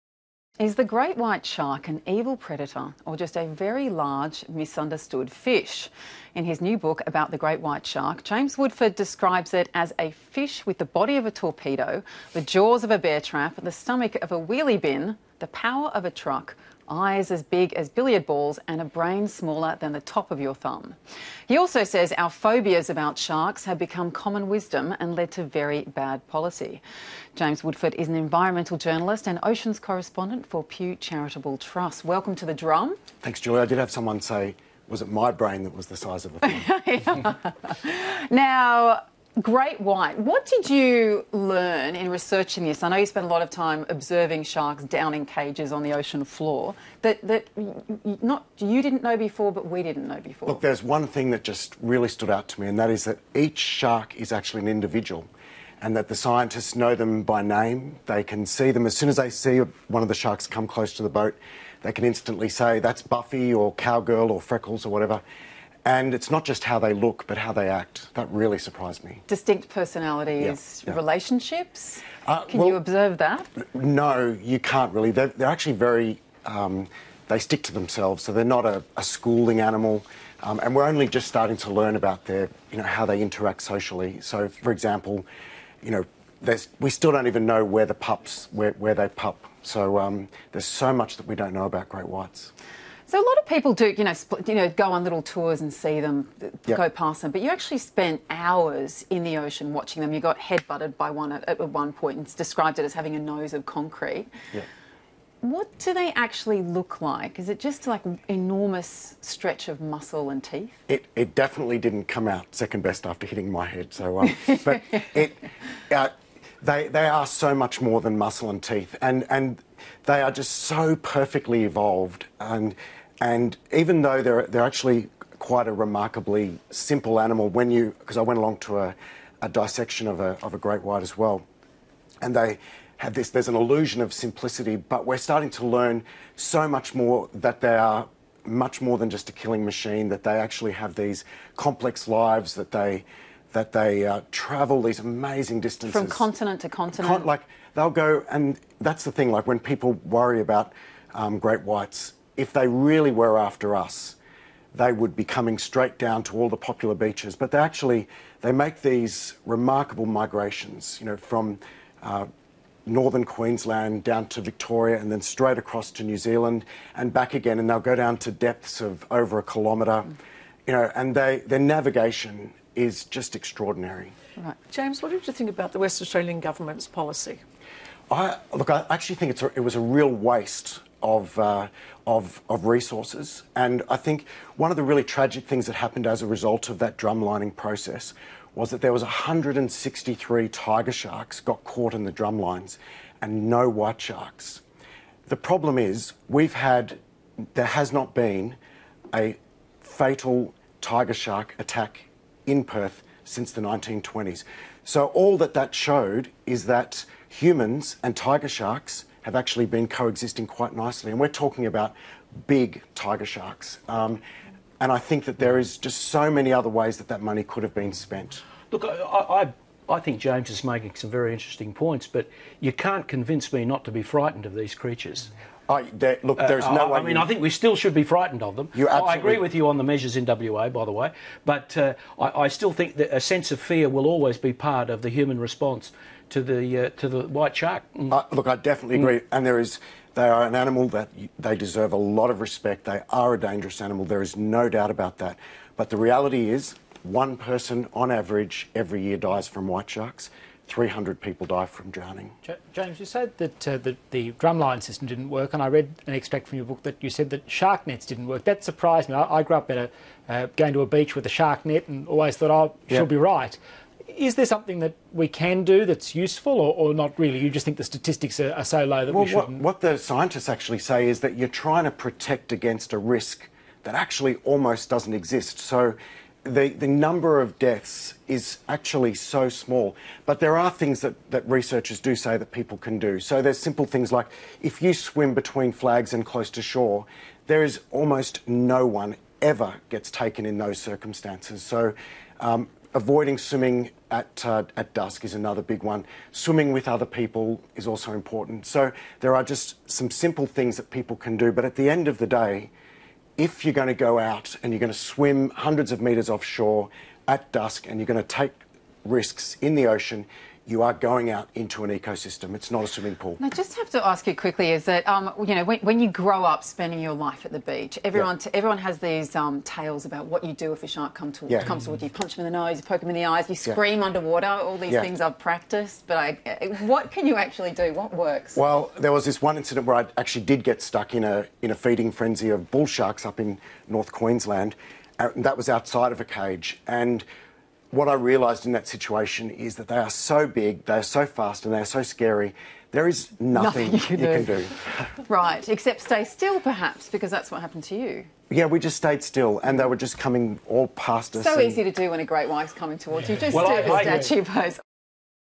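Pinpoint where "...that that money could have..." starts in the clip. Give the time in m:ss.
3:36.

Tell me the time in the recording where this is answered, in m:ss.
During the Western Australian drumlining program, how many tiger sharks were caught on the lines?
3:09.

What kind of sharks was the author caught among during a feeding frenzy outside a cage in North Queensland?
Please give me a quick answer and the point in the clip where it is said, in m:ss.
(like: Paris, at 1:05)
bull sharks, at 5:32.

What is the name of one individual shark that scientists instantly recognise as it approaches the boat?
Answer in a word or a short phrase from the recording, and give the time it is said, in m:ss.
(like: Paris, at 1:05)
Buffy, at 1:03.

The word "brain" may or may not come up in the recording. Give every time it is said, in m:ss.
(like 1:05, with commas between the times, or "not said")
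0:18, 0:35.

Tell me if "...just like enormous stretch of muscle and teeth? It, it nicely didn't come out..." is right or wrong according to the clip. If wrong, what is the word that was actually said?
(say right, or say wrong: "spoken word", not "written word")
wrong: "definitely", not "nicely".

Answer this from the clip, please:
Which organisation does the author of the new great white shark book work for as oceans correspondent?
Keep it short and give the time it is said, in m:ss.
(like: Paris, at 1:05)
Pew Charitable Trust, at 0:30.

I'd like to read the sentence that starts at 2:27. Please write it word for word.
Con like they'll go, and that's the thing.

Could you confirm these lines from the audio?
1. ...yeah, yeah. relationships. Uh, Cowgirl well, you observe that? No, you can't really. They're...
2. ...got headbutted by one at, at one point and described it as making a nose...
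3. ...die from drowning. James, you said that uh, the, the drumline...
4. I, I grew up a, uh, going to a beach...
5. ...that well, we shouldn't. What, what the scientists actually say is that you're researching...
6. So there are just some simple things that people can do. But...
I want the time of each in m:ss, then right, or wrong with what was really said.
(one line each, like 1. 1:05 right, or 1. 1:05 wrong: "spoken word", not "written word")
1. 1:10 wrong: "Can", not "Cowgirl"
2. 1:40 wrong: "having", not "making"
3. 4:11 right
4. 4:19 right
5. 4:29 wrong: "trying", not "researching"
6. 4:58 right.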